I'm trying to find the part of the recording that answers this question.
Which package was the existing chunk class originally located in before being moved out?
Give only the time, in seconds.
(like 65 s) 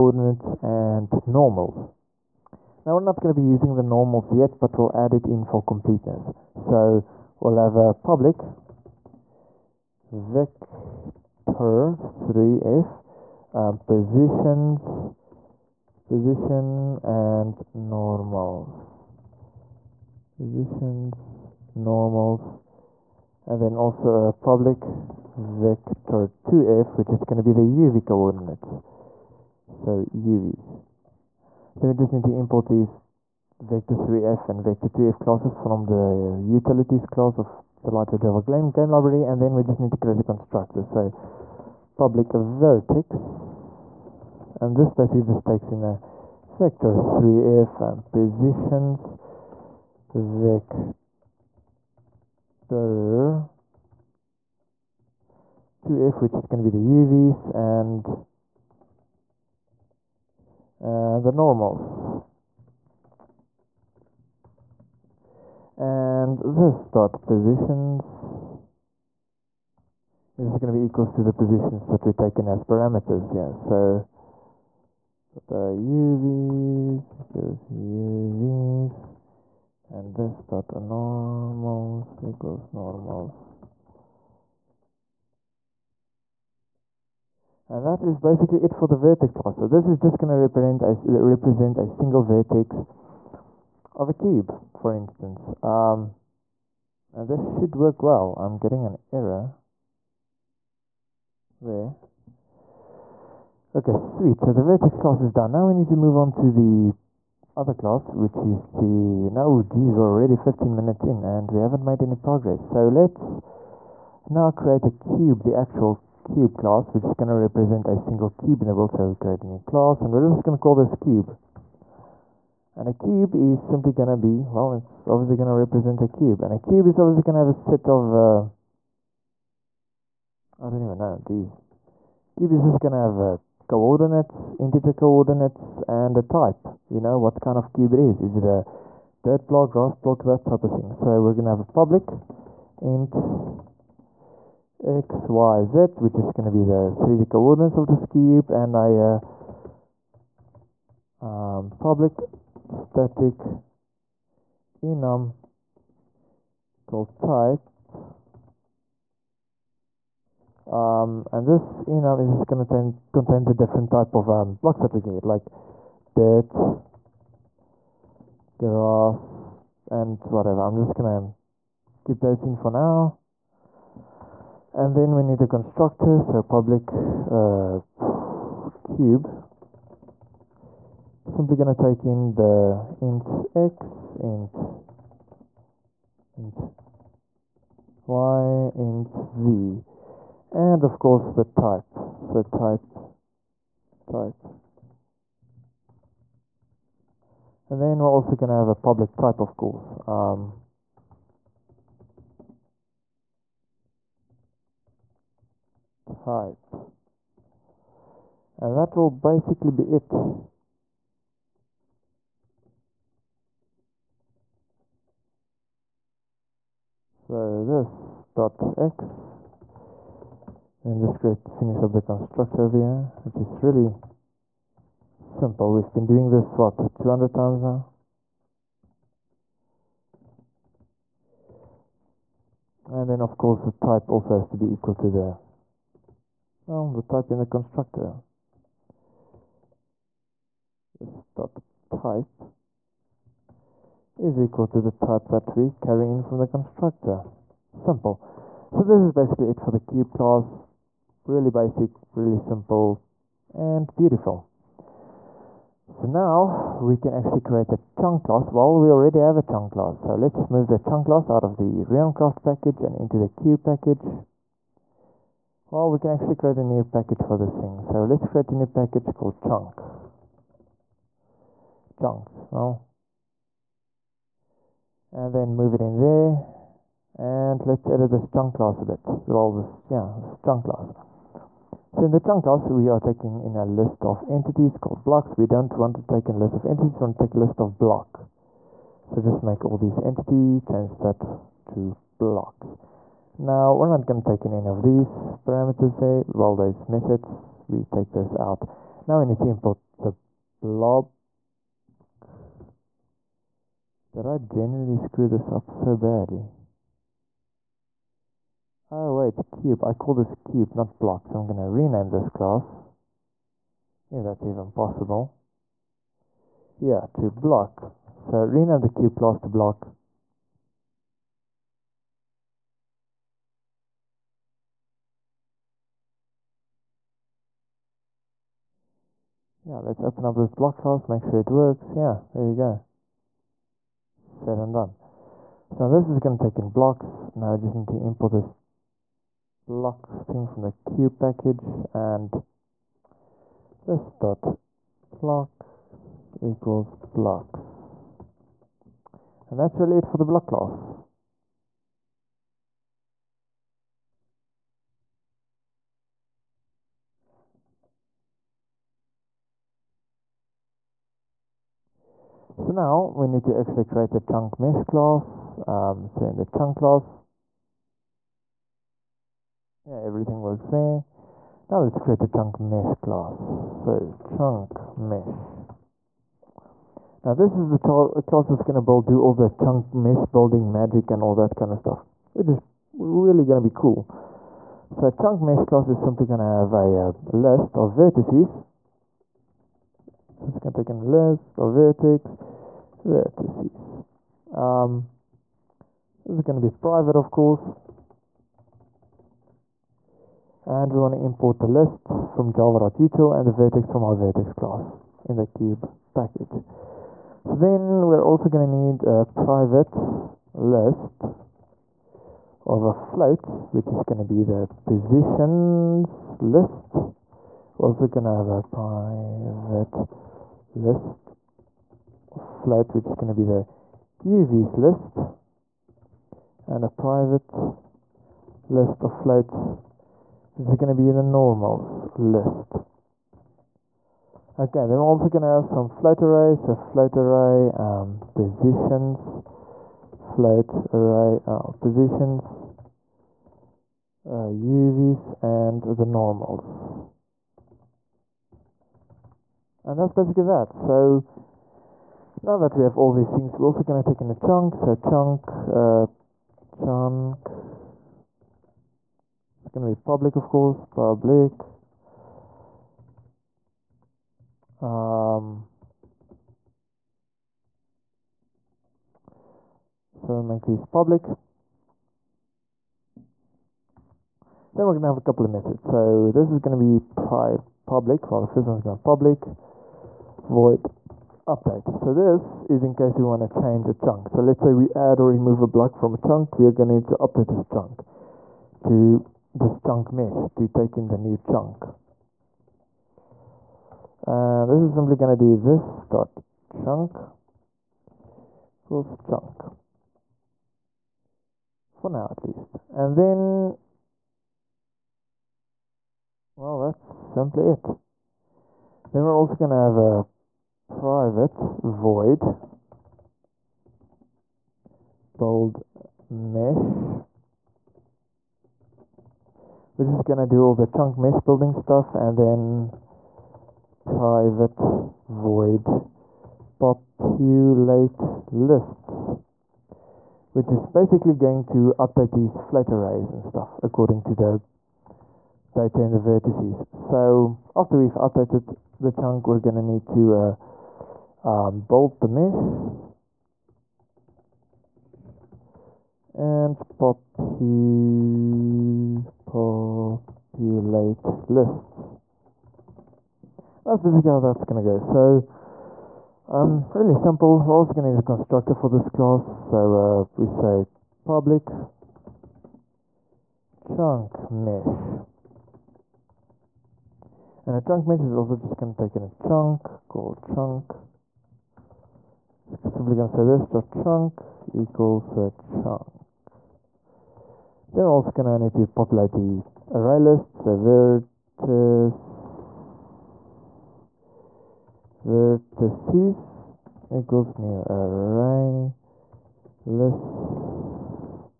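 261 s.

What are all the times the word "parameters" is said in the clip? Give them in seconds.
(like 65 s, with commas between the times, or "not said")
72 s, 295 s.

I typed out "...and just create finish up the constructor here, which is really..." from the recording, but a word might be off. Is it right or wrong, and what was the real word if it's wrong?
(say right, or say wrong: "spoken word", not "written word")
right.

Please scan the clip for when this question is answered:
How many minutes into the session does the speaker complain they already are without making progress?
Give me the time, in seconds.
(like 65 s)
110 s.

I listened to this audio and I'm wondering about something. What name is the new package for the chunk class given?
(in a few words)
chunks.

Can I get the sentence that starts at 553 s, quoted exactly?
That's basically how that's going to go.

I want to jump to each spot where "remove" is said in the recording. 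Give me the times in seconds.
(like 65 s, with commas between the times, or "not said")
485 s.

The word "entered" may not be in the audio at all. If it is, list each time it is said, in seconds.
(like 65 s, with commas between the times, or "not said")
not said.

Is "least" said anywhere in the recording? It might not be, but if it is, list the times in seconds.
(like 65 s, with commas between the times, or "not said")
502 s.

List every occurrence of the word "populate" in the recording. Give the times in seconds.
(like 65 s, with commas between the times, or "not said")
526 s, 549 s, 578 s.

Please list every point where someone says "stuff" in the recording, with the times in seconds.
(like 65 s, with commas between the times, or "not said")
381 s, 521 s, 533 s.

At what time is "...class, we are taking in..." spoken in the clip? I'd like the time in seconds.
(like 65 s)
282 s.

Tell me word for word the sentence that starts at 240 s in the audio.
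This dot type is equal to the type that we carry in from the constructor simple.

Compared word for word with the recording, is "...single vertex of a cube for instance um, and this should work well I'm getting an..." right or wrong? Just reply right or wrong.
right.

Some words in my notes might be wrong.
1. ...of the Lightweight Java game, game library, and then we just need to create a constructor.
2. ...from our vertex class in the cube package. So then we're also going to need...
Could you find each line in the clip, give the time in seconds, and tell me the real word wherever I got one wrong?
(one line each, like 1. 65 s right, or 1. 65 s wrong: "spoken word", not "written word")
1. 37 s right
2. 403 s right.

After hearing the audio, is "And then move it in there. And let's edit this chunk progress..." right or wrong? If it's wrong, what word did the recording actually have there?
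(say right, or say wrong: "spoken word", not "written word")
wrong: "class", not "progress".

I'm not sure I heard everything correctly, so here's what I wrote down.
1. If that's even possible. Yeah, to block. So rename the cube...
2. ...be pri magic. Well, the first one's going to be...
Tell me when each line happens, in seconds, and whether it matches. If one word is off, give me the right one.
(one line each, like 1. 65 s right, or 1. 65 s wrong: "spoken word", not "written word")
1. 314 s right
2. 476 s wrong: "public", not "magic".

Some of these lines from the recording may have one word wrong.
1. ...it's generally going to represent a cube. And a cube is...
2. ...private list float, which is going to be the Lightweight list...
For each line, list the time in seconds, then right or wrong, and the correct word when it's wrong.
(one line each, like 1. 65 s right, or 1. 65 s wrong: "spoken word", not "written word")
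1. 124 s wrong: "obviously", not "generally"
2. 418 s wrong: "UVs", not "Lightweight".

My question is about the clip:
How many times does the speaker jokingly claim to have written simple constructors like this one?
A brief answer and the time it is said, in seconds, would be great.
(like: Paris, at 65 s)
200, at 226 s.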